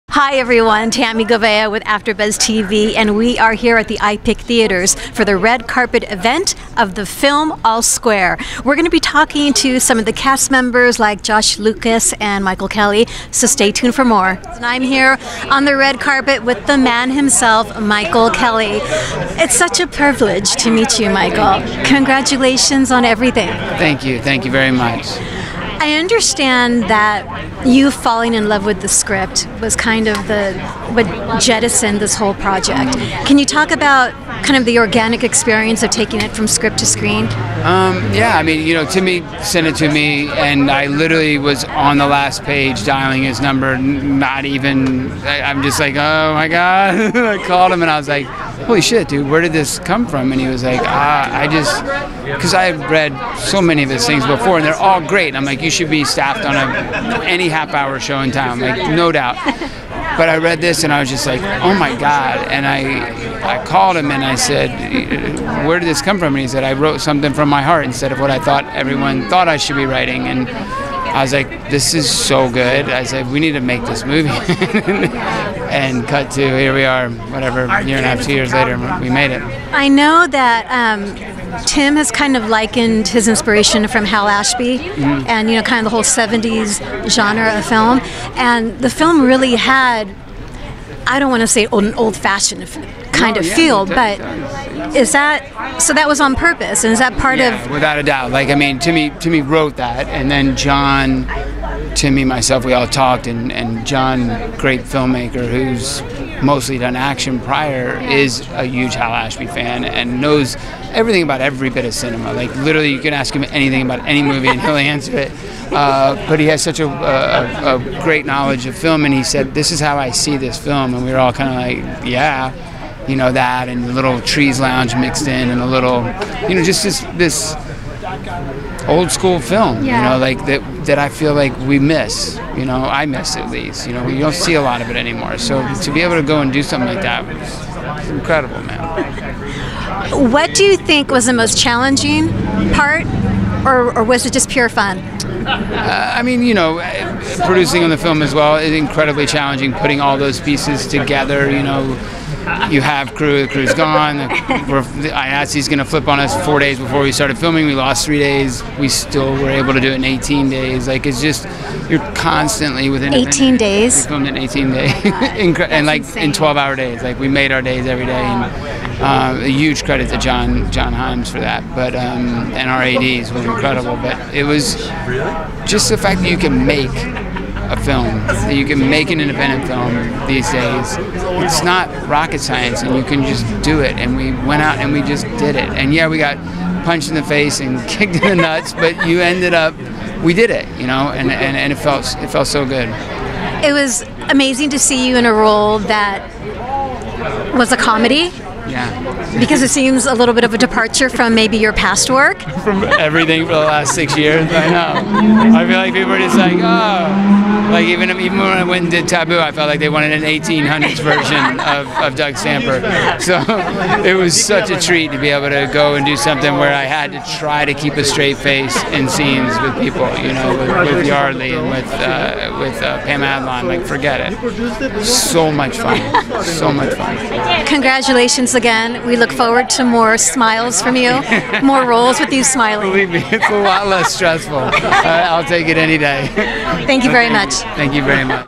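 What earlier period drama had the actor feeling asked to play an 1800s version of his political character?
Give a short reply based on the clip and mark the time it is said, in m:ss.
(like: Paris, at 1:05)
Taboo, at 3:29.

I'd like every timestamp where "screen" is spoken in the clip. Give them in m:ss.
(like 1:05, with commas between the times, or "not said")
0:36.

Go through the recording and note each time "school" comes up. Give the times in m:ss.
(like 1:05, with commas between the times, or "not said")
2:09.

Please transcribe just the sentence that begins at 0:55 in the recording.
And I'm like, you should be staffed on a, any half hour show in town, like no doubt.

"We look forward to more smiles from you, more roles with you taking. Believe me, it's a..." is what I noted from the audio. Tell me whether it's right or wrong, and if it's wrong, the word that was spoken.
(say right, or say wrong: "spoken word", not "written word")
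wrong: "smiling", not "taking".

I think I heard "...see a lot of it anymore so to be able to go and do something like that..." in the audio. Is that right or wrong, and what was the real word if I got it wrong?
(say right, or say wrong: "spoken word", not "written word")
right.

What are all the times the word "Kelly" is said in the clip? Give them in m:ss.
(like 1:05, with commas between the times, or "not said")
0:12, 0:18.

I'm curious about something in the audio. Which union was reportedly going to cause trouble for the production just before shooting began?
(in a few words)
IATSE.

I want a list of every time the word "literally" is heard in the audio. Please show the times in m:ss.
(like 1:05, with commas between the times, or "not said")
0:40, 1:52.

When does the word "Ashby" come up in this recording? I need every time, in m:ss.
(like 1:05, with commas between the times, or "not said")
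1:24, 1:49.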